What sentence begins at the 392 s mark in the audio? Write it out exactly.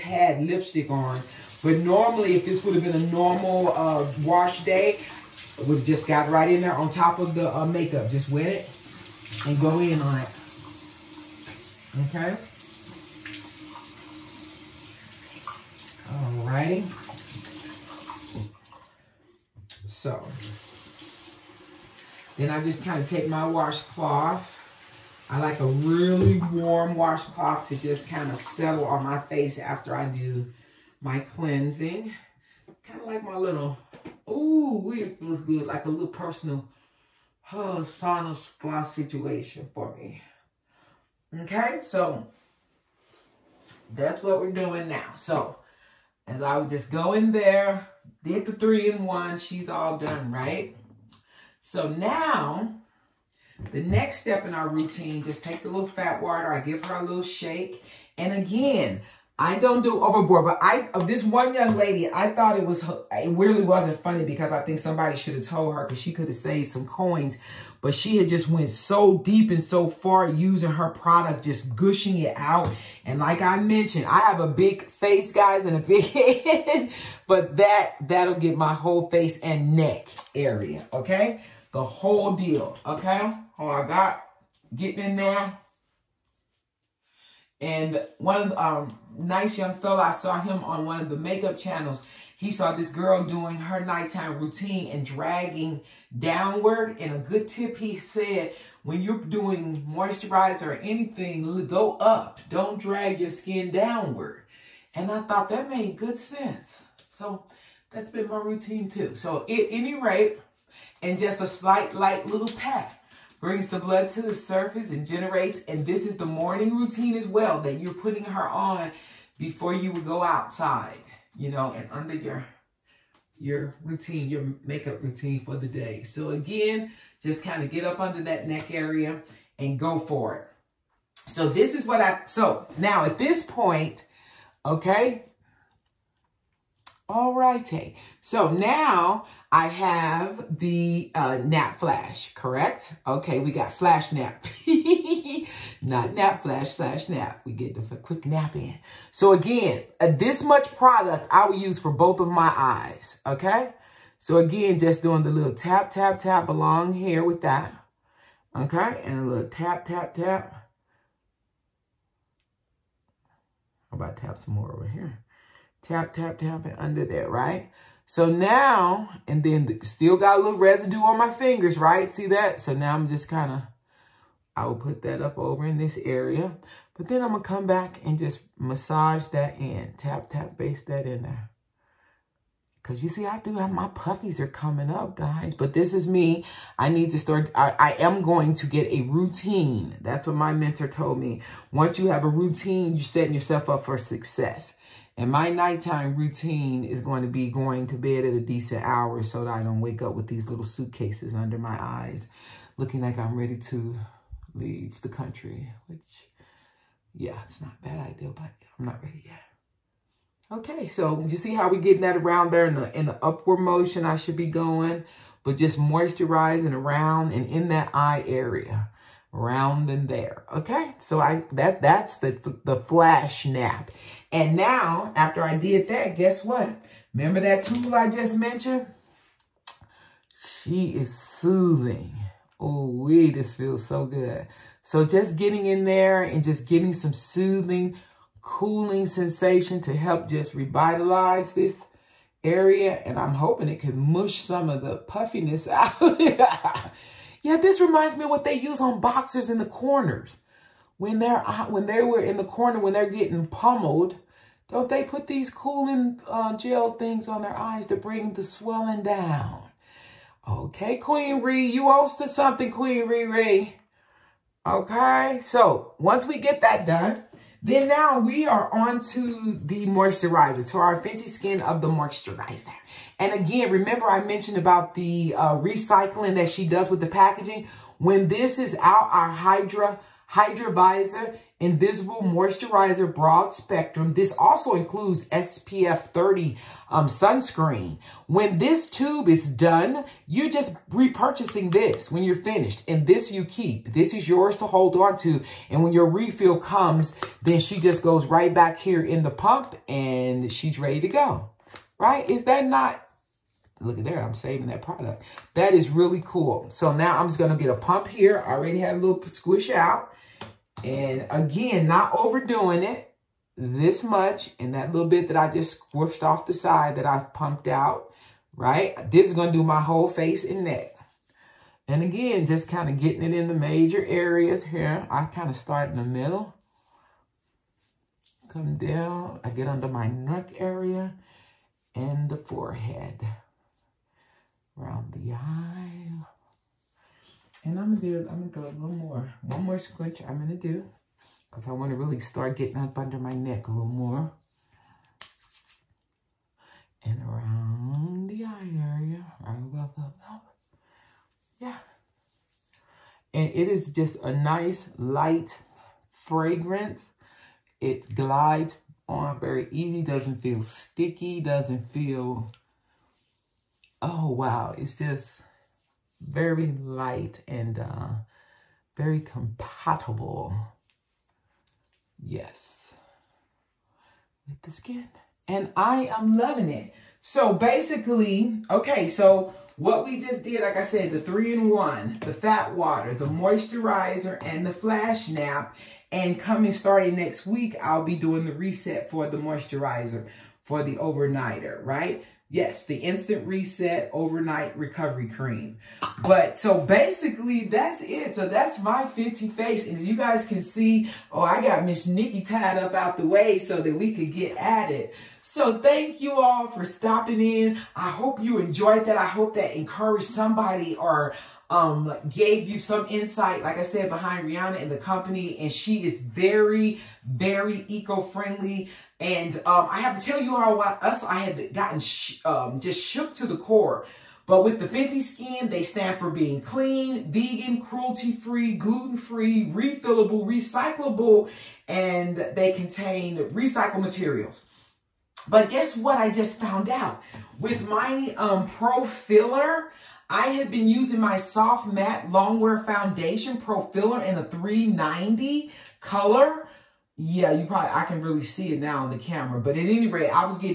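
Yes, the instant reset overnight recovery cream.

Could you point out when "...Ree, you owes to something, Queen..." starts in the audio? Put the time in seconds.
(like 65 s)
261 s.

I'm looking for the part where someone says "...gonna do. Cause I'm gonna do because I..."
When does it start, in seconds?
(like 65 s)
340 s.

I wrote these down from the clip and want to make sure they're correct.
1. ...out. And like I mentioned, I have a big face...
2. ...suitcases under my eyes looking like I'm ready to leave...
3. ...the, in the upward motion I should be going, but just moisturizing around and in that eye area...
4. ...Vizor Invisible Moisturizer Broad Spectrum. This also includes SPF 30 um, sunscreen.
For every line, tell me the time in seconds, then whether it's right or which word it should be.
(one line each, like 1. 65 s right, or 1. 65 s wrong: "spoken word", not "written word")
1. 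72 s right
2. 200 s right
3. 212 s right
4. 280 s right.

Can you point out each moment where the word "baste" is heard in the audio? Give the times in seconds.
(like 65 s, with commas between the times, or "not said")
180 s.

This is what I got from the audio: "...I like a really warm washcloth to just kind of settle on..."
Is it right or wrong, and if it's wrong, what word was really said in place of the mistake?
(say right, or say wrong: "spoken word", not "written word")
right.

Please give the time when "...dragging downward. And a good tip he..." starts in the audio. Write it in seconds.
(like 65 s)
95 s.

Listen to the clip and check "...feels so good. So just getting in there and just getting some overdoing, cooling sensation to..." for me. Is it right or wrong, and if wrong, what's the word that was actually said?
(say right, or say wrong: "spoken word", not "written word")
wrong: "soothing", not "overdoing".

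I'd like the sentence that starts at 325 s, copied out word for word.
I kind of start in the middle.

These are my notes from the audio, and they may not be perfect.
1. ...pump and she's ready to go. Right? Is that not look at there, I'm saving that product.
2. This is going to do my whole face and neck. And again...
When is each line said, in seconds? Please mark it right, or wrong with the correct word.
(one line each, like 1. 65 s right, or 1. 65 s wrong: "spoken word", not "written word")
1. 299 s right
2. 319 s right.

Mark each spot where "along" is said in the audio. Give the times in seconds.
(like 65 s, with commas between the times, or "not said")
156 s.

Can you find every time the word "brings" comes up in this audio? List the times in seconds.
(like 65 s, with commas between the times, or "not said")
113 s, 257 s.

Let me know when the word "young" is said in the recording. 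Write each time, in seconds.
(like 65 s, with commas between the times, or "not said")
61 s, 89 s.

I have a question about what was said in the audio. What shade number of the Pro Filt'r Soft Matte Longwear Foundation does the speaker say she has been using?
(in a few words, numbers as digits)
390.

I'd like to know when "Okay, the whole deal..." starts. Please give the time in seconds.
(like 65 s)
80 s.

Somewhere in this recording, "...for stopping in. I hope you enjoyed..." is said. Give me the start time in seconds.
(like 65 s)
406 s.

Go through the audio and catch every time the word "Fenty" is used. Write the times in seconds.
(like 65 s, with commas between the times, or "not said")
271 s, 424 s.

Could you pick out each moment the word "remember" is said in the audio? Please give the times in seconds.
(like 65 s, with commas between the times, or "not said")
227 s, 273 s.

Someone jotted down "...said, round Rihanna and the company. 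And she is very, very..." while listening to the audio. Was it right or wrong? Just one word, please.
wrong.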